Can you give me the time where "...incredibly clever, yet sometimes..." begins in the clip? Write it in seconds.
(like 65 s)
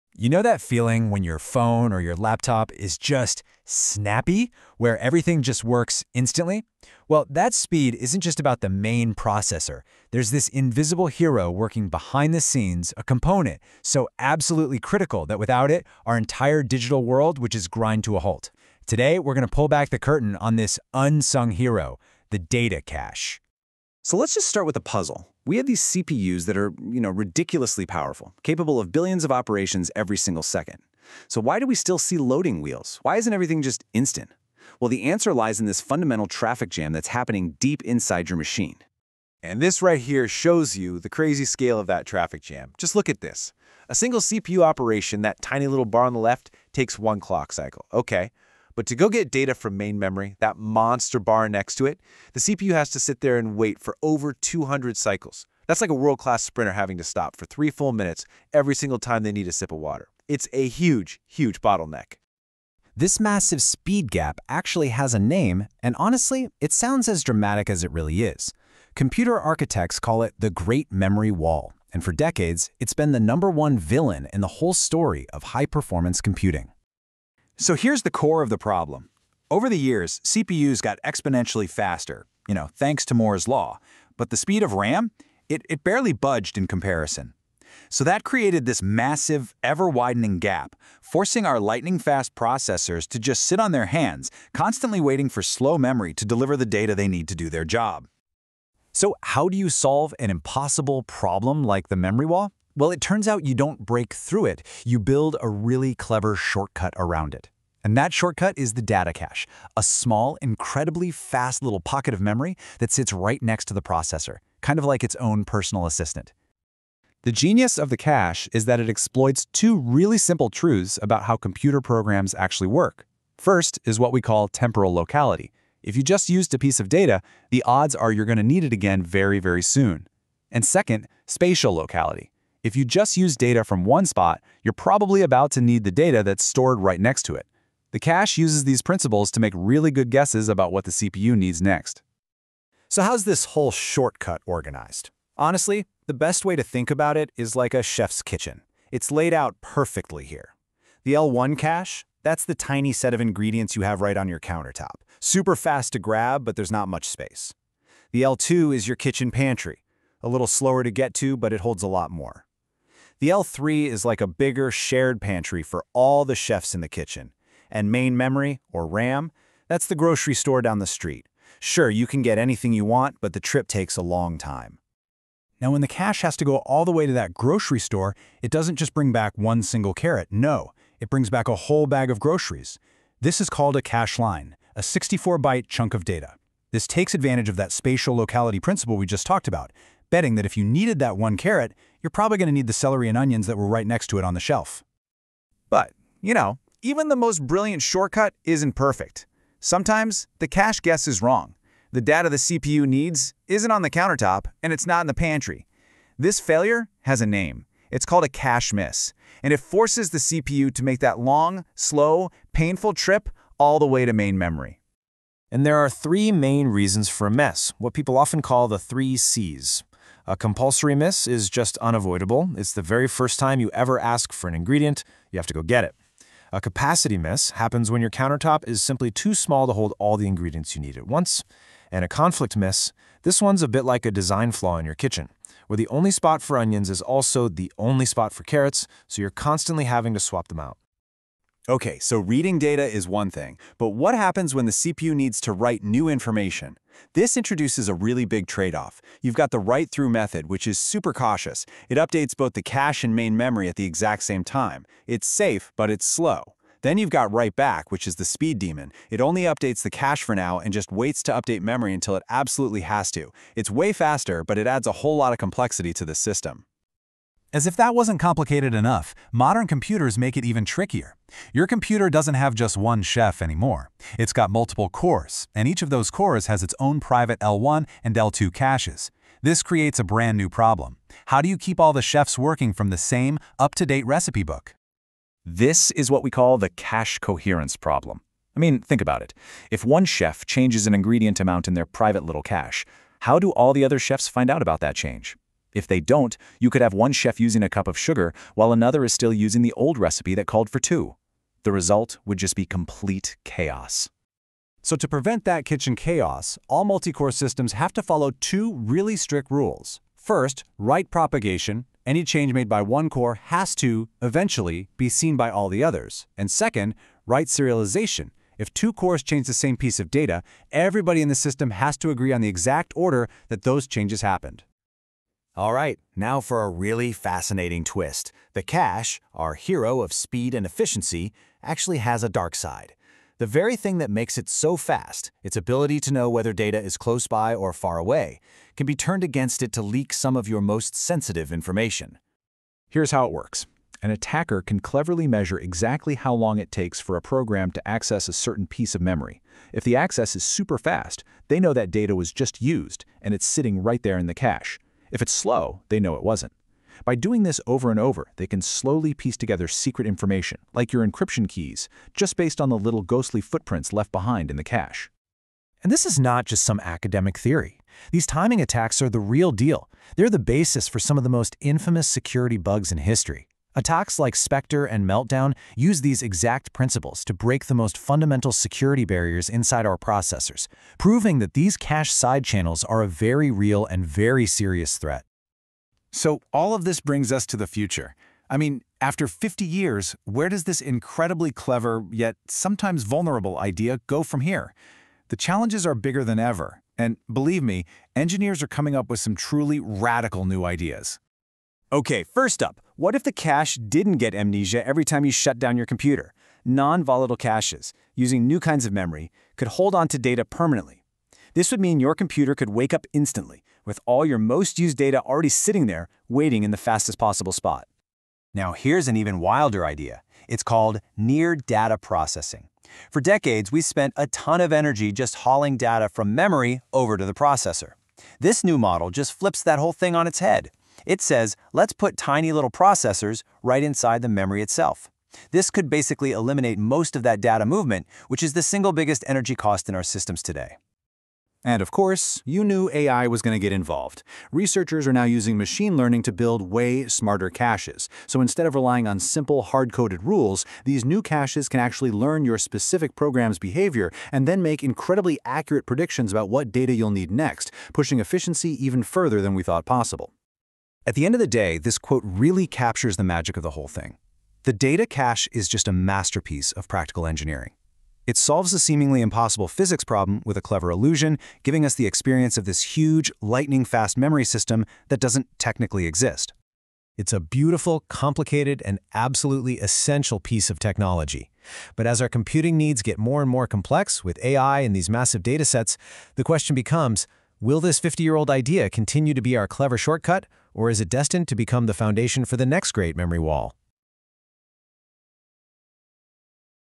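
390 s.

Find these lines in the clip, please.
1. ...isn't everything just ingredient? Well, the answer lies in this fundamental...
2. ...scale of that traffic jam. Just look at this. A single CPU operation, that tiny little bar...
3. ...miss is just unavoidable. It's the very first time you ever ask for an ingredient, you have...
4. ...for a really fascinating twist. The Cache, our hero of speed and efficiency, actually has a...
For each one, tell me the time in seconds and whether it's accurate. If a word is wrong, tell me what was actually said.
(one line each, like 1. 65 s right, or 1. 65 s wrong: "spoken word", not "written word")
1. 33 s wrong: "instant", not "ingredient"
2. 41 s right
3. 220 s right
4. 326 s right.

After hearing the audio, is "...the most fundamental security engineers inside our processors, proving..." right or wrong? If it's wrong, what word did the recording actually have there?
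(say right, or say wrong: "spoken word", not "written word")
wrong: "barriers", not "engineers".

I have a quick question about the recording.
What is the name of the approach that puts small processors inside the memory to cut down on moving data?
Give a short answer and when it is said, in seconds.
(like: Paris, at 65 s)
near data processing, at 421 s.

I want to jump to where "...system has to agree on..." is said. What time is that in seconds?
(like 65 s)
321 s.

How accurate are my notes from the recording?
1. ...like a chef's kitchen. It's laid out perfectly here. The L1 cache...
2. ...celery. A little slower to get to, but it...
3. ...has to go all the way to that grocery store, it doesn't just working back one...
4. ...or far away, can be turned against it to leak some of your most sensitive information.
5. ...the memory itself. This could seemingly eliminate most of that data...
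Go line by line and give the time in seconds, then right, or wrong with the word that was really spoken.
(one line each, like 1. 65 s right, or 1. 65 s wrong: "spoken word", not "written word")
1. 147 s right
2. 159 s wrong: "pantry", not "celery"
3. 176 s wrong: "bring", not "working"
4. 337 s right
5. 434 s wrong: "basically", not "seemingly".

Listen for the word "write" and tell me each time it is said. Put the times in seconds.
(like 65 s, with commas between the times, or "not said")
245 s, 249 s, 257 s, 310 s, 317 s.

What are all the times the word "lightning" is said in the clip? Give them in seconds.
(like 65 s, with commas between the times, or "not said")
91 s, 473 s.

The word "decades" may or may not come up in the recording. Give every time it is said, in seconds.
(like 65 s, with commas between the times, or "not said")
72 s, 423 s.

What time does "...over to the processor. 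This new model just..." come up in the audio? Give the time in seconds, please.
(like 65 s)
426 s.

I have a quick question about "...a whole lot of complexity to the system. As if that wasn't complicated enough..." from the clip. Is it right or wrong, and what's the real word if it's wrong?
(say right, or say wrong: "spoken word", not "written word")
right.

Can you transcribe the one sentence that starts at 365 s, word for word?
And this is not just some academic theory.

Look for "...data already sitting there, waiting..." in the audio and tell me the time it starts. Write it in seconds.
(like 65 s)
414 s.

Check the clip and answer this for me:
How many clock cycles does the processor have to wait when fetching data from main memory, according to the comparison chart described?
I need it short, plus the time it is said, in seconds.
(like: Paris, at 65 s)
over 200, at 54 s.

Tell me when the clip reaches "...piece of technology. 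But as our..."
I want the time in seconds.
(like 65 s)
480 s.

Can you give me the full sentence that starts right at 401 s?
Okay, first up, what if the cache didn't get amnesia every time you shut down your computer?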